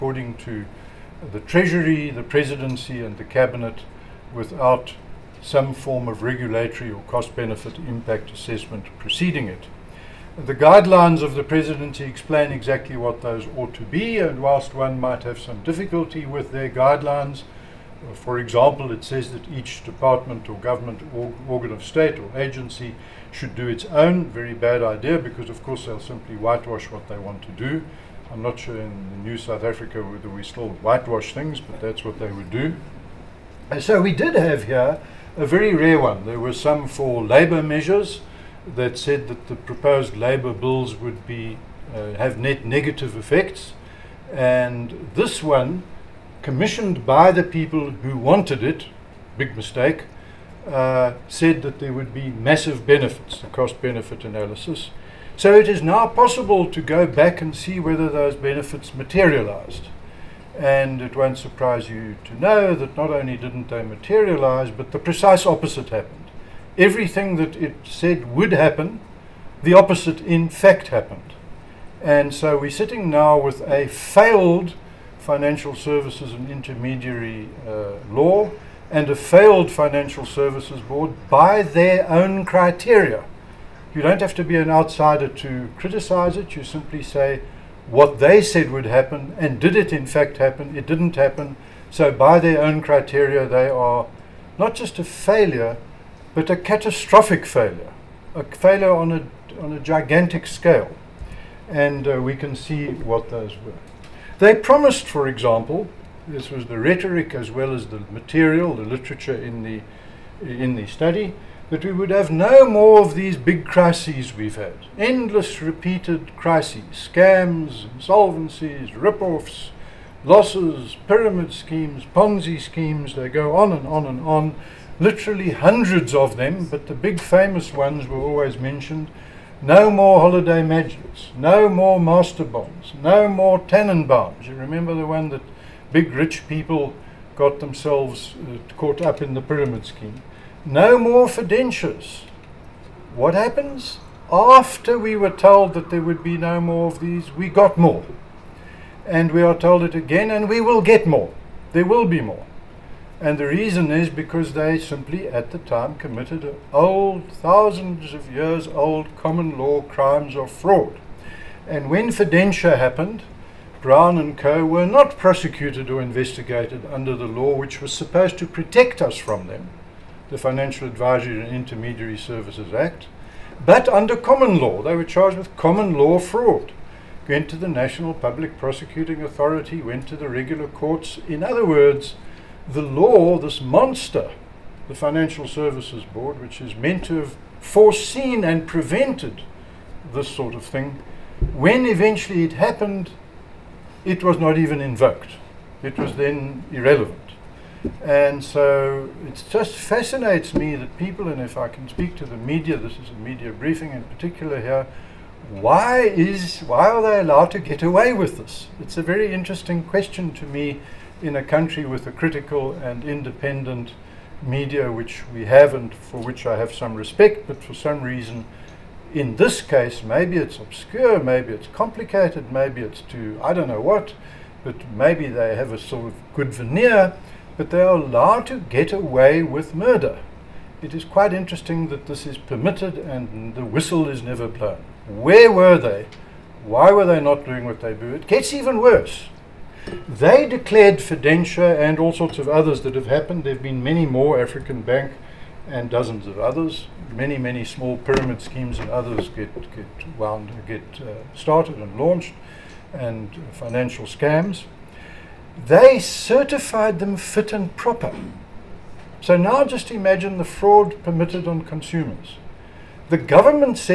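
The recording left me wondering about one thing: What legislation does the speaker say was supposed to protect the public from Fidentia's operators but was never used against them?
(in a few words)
Financial Advisory and Intermediary Services Act.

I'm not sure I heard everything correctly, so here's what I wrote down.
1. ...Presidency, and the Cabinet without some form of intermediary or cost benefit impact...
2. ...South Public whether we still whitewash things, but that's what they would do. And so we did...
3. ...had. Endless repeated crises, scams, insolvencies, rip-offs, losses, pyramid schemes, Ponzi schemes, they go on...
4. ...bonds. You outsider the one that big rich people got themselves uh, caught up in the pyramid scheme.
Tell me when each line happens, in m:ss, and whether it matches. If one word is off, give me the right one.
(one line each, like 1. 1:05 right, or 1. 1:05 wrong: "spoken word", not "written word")
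1. 0:02 wrong: "regulatory", not "intermediary"
2. 0:29 wrong: "Africa", not "Public"
3. 1:54 right
4. 2:13 wrong: "remember", not "outsider".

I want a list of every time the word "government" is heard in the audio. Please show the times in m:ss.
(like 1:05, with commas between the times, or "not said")
0:20, 4:23.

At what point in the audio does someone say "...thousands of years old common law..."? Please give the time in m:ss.
2:37.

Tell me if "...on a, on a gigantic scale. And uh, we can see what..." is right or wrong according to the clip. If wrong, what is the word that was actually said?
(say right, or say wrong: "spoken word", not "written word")
right.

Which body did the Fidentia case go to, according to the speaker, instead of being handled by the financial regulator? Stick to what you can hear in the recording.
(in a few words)
National Public Prosecuting Authority.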